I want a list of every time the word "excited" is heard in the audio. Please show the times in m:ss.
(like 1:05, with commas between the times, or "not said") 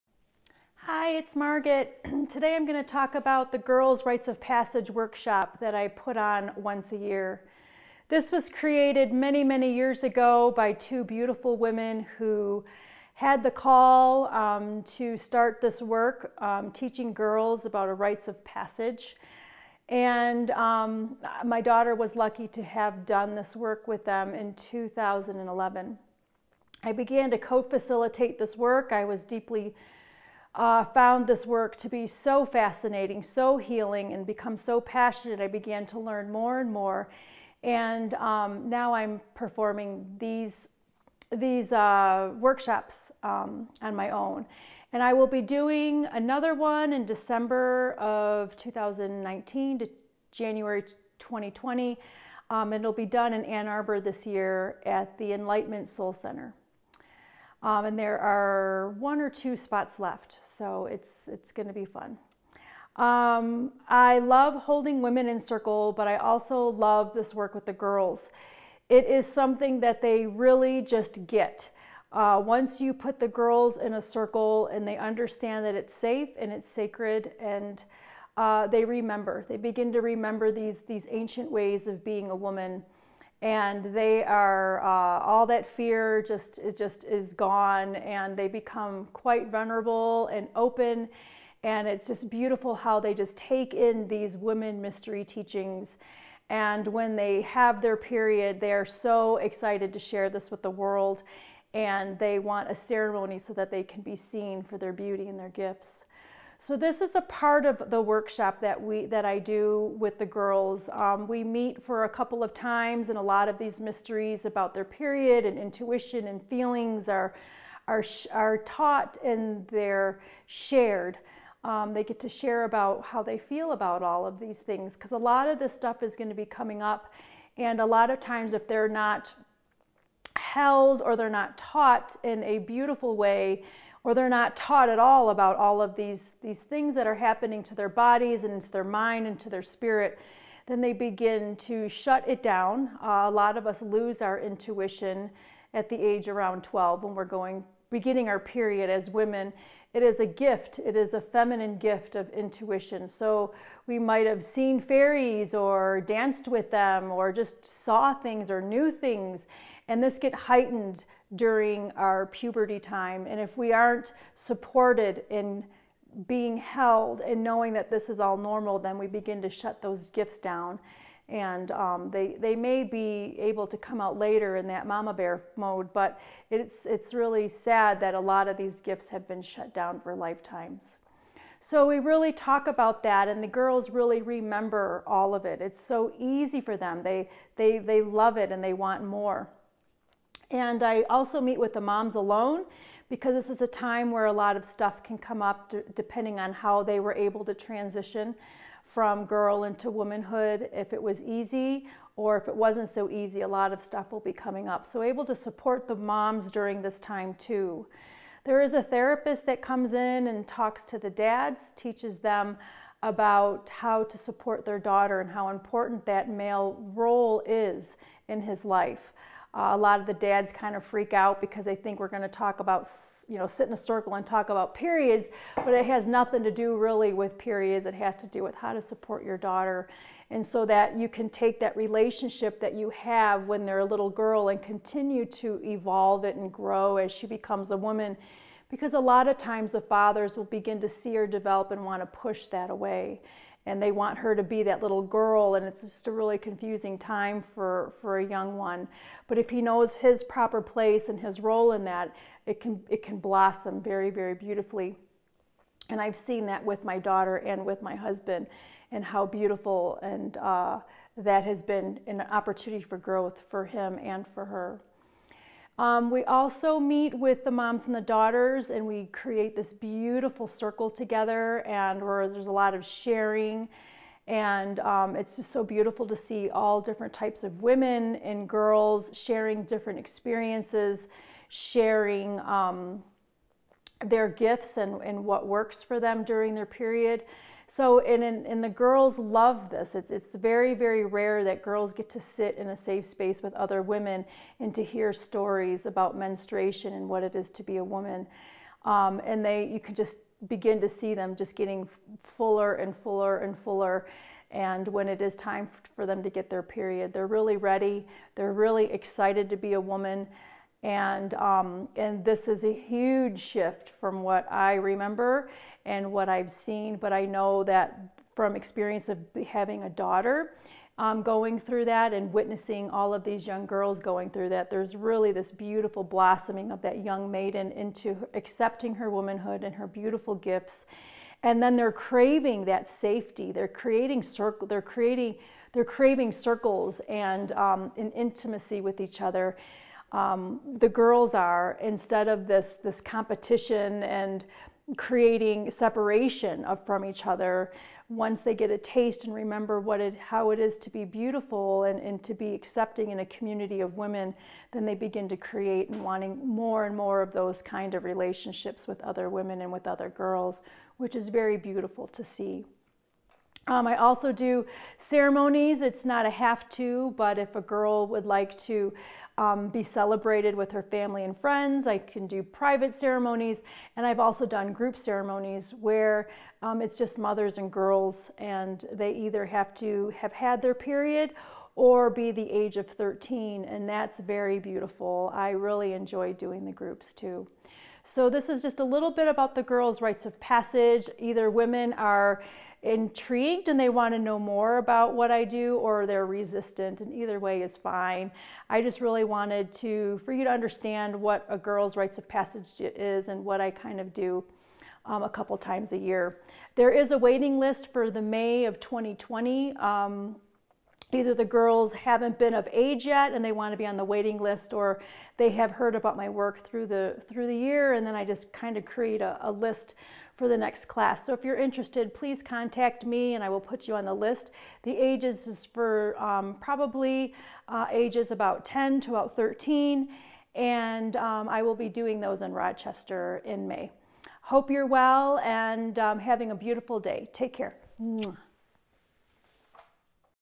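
1:39, 5:08.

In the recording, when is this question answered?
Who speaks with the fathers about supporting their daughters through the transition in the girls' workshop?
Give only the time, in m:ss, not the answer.
3:28.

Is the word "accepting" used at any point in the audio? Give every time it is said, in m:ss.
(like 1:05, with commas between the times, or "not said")
5:28, 5:52.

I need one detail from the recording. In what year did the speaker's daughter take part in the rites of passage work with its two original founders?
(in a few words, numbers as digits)
2011.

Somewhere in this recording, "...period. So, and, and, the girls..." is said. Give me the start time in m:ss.
4:46.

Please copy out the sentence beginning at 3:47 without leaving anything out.
It has to do with how to support your daughter.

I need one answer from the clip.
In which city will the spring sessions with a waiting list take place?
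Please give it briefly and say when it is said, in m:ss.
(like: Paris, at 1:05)
Rochester, at 7:12.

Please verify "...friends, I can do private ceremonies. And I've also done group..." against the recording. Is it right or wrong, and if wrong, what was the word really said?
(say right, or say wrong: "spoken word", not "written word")
right.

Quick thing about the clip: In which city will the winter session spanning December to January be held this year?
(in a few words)
Ann Arbor.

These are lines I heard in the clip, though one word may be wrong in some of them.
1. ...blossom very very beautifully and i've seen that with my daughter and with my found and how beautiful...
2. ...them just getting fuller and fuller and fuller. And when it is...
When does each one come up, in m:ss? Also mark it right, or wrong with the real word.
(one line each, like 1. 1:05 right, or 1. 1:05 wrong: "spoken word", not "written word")
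1. 4:13 wrong: "husband", not "found"
2. 5:01 right.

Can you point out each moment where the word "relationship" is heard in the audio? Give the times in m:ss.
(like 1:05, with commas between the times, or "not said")
3:51, 5:58.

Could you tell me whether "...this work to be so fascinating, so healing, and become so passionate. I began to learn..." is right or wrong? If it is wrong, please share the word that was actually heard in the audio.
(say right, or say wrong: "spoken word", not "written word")
right.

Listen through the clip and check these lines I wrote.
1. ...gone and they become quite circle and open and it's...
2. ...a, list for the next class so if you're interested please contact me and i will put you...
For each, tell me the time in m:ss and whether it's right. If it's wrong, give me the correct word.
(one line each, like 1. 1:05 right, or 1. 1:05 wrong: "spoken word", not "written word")
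1. 1:27 wrong: "vulnerable", not "circle"
2. 6:59 right.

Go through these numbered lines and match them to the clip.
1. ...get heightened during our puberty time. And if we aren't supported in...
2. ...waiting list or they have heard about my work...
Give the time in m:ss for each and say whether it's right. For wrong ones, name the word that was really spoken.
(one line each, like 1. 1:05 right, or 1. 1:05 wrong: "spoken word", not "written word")
1. 2:40 right
2. 6:54 right.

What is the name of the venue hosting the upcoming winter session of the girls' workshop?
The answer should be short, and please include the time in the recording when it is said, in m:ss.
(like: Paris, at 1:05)
Enlightenment Soul Center, at 0:55.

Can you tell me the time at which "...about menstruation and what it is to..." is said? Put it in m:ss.
4:55.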